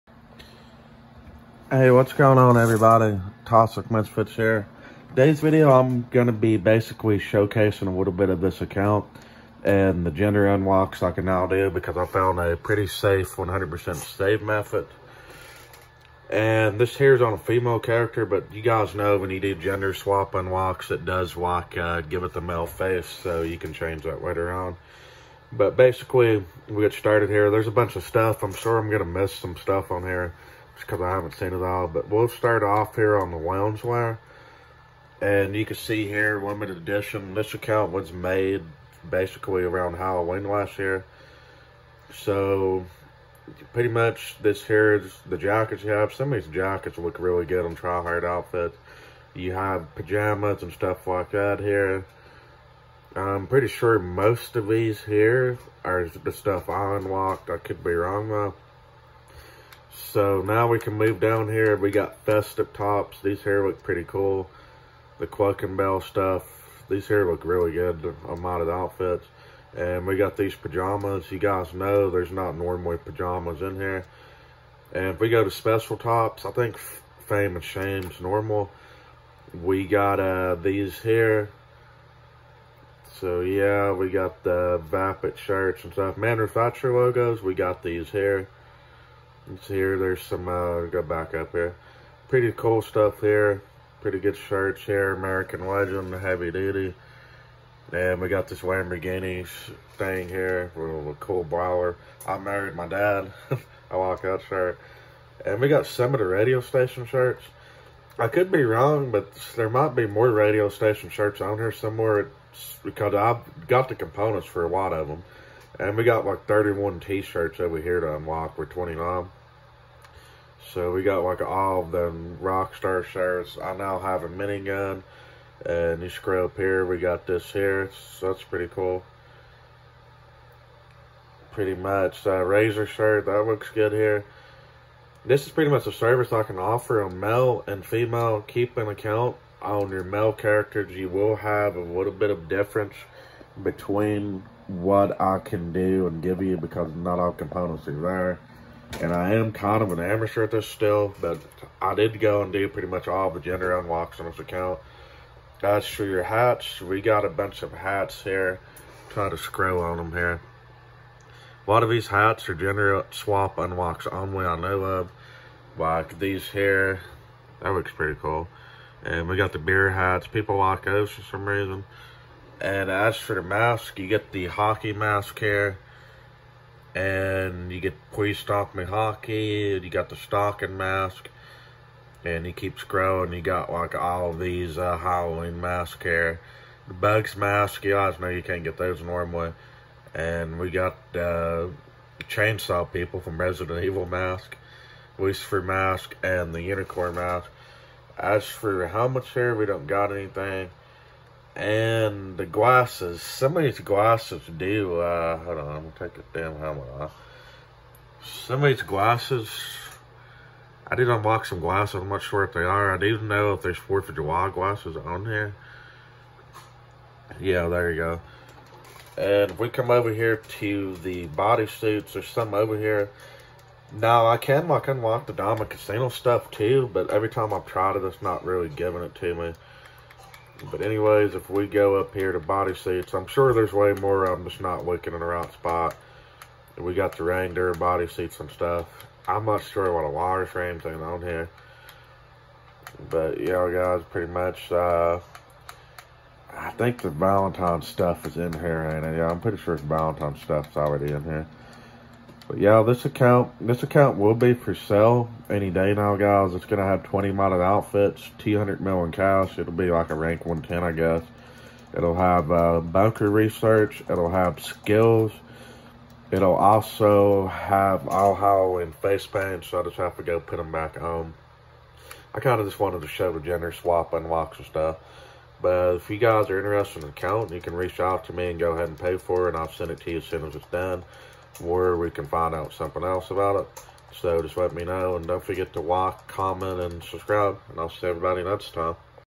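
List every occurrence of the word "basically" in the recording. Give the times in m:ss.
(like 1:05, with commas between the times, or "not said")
0:06, 0:25, 0:39.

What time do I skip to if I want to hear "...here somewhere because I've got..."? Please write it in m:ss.
1:51.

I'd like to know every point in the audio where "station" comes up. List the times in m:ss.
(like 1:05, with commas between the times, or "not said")
1:46, 1:50.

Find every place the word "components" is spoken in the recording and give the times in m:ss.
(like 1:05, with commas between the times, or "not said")
1:53, 2:27.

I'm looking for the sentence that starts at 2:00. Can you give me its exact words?
So we got like all of them Rockstar shirts.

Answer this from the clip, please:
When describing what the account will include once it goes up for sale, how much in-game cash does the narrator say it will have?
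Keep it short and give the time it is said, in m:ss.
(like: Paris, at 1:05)
200 million, at 4:18.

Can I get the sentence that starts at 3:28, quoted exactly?
Somebody's glasses, I did unbox some glasses, I'm not sure if they are.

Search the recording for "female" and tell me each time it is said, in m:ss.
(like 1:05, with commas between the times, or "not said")
0:17, 2:17.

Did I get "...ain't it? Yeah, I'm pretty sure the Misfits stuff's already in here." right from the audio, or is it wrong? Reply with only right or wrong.
wrong.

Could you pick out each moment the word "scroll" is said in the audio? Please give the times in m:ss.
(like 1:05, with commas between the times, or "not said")
2:06, 2:39.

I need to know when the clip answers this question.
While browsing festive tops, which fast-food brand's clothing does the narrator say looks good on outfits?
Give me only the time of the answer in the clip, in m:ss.
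1:05.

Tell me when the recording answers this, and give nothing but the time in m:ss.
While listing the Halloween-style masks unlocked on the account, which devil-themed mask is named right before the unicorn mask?
3:15.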